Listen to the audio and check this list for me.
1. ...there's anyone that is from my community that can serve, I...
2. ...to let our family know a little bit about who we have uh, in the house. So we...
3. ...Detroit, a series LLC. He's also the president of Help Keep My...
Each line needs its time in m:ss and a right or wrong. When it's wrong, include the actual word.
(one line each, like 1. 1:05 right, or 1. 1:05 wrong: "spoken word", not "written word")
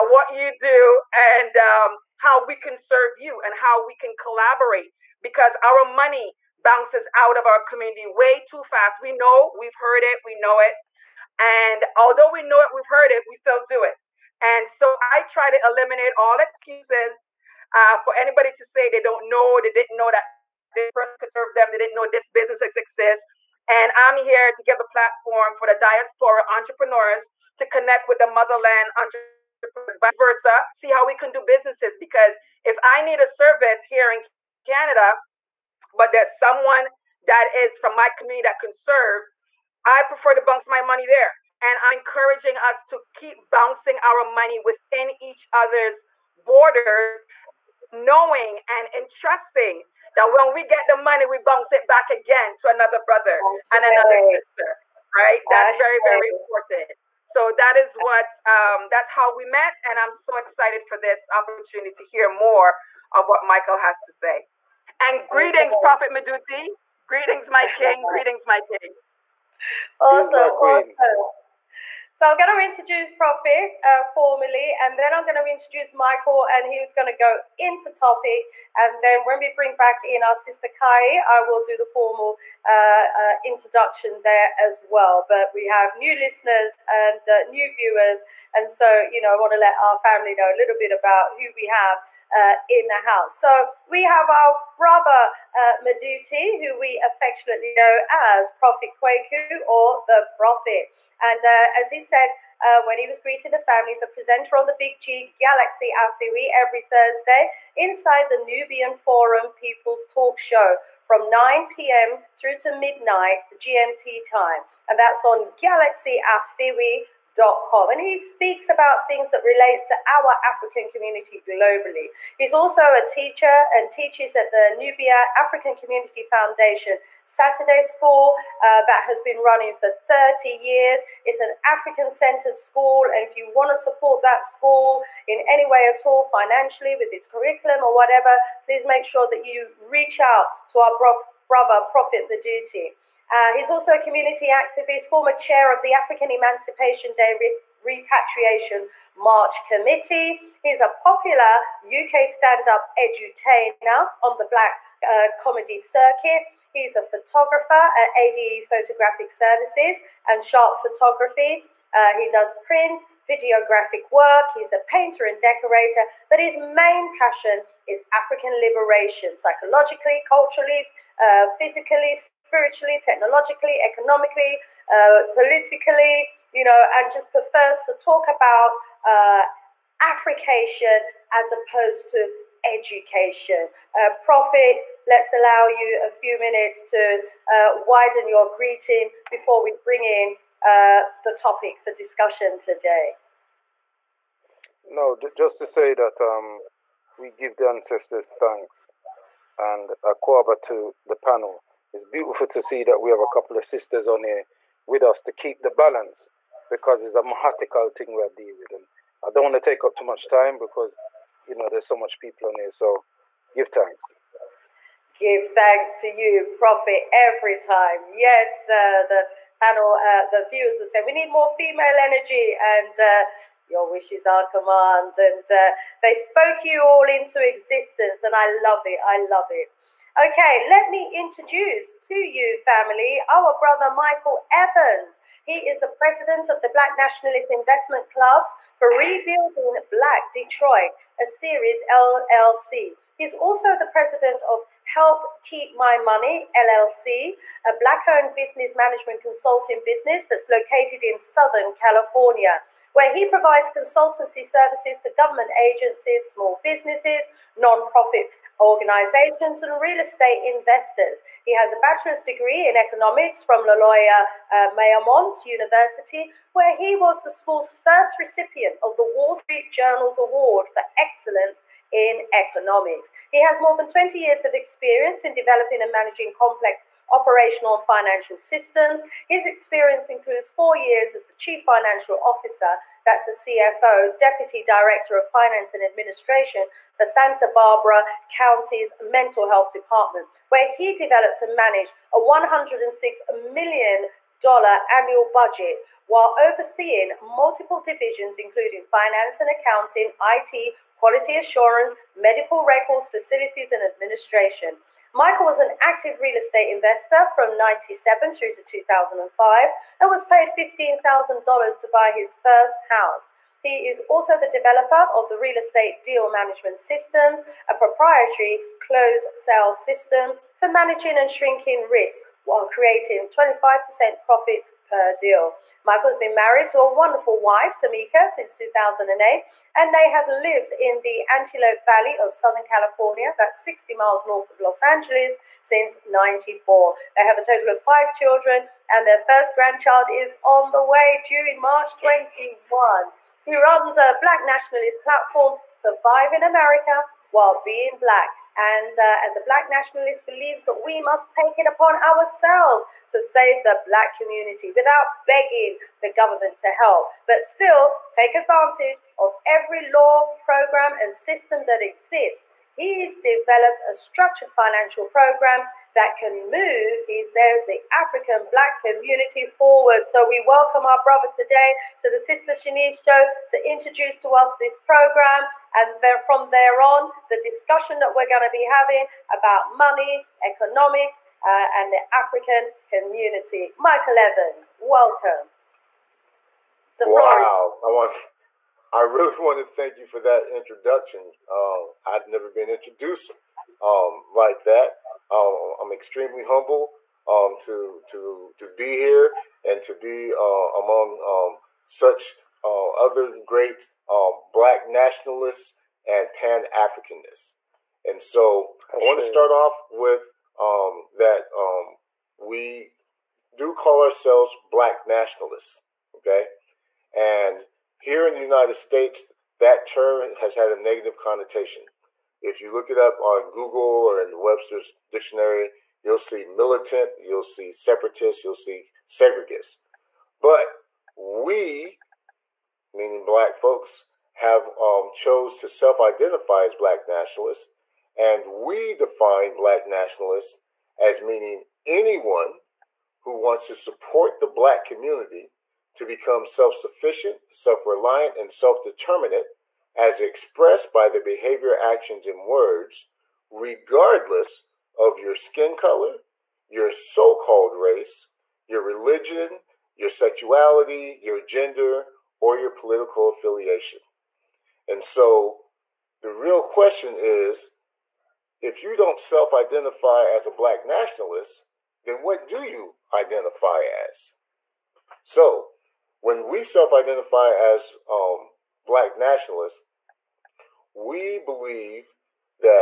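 1. 0:36 wrong: "someone", not "anyone"
2. 1:29 right
3. 4:00 right.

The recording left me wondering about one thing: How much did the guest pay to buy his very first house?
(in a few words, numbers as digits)
$15,000.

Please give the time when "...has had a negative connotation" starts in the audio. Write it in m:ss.
7:00.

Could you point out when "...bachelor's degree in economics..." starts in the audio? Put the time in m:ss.
4:21.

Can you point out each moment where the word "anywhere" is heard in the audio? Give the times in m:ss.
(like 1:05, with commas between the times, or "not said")
not said.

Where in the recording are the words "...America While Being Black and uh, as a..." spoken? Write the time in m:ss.
5:46.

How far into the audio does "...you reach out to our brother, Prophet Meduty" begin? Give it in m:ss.
2:19.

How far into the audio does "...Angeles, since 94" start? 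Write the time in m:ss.
5:34.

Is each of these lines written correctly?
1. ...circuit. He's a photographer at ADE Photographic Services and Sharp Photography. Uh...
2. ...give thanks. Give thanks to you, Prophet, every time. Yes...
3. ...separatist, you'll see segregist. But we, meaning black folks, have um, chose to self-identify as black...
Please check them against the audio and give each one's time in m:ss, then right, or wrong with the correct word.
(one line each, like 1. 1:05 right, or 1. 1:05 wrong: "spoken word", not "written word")
1. 2:35 right
2. 3:33 right
3. 7:07 right.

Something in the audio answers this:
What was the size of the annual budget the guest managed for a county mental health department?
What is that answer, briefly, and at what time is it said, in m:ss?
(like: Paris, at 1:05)
$106 million, at 4:52.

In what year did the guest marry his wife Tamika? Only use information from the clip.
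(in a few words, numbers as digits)
2008.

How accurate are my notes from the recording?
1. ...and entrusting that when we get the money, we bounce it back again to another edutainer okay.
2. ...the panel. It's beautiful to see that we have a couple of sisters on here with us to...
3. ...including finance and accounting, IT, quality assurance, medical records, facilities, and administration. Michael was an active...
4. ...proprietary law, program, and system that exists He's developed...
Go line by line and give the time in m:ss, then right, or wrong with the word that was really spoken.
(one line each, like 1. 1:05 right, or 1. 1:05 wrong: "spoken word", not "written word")
1. 0:48 wrong: "brother", not "edutainer"
2. 3:21 right
3. 4:58 right
4. 5:59 wrong: "every", not "proprietary".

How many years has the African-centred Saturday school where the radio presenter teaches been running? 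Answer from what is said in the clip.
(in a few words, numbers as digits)
30 years.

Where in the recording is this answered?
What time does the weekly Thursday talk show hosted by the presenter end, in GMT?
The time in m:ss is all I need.
1:52.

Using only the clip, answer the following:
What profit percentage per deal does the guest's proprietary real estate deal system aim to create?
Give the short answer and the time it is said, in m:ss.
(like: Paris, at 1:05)
25%, at 5:23.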